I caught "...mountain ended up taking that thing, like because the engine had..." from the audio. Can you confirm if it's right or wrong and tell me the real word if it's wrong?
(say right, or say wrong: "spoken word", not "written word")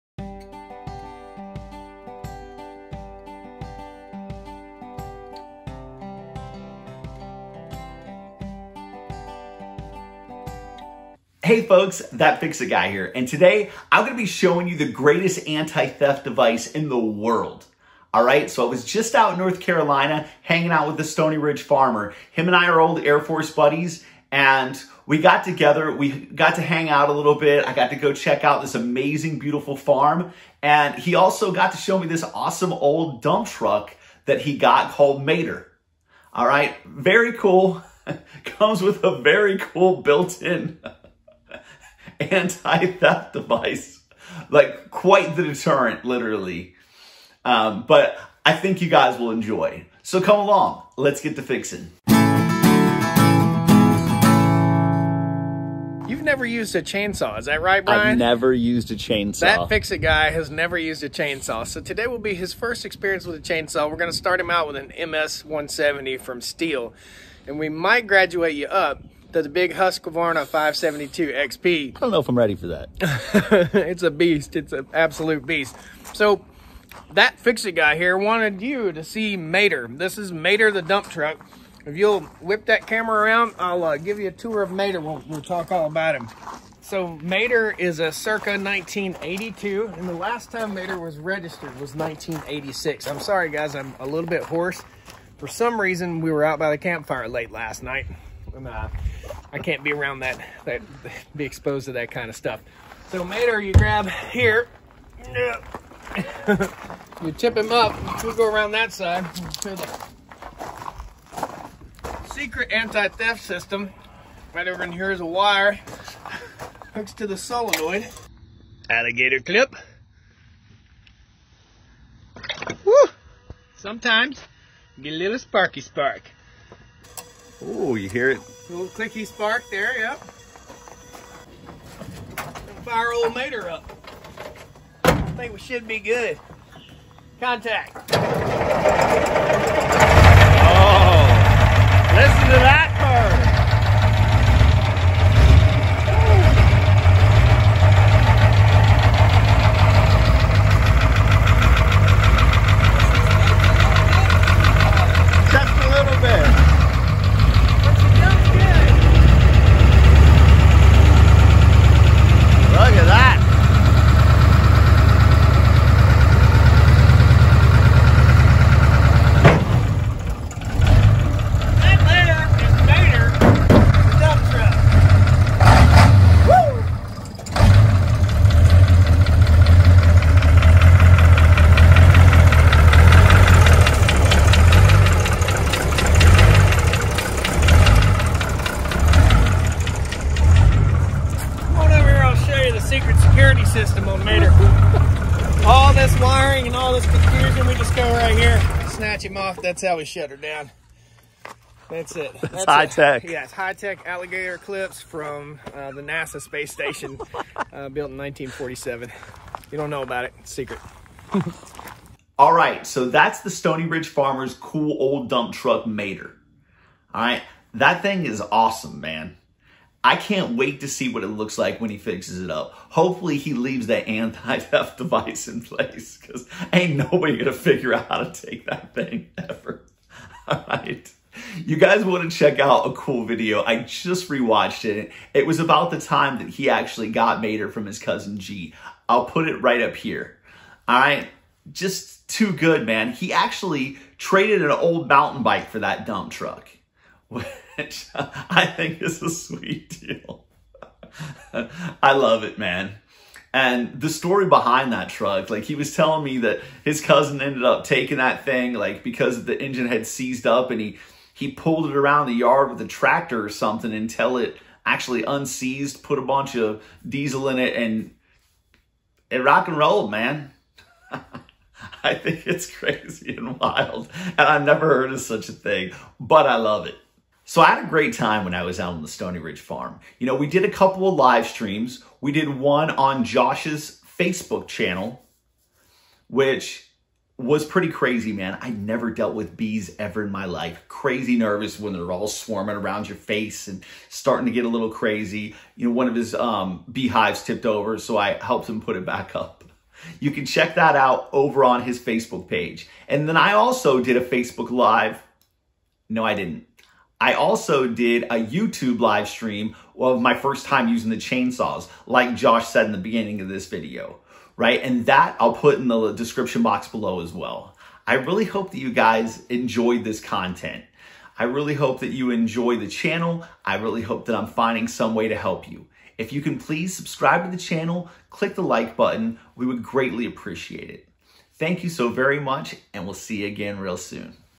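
wrong: "cousin", not "mountain".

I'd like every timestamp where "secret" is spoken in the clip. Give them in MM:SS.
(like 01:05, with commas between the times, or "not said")
01:52, 03:30.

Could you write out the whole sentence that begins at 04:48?
I never dealt with bees ever in my life.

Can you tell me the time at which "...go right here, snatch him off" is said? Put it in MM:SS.
03:17.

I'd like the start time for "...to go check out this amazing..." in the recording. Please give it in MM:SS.
00:27.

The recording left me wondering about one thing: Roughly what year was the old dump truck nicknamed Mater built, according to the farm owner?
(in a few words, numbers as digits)
1982.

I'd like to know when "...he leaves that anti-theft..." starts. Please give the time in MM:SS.
03:43.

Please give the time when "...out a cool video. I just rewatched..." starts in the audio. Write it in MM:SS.
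03:52.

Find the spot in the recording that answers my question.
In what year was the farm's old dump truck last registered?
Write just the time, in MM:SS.
01:31.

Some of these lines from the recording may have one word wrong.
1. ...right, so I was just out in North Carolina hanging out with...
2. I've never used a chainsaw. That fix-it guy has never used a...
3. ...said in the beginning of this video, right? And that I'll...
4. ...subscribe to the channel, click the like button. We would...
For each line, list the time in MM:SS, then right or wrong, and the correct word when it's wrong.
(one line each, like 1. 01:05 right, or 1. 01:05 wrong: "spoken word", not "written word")
1. 00:18 right
2. 00:58 right
3. 05:12 right
4. 05:26 right.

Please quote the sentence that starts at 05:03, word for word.
And then I also did a Facebook Live.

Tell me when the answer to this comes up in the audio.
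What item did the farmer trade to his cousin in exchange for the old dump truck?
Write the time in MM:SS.
04:05.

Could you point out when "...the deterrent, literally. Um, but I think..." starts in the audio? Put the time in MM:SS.
00:45.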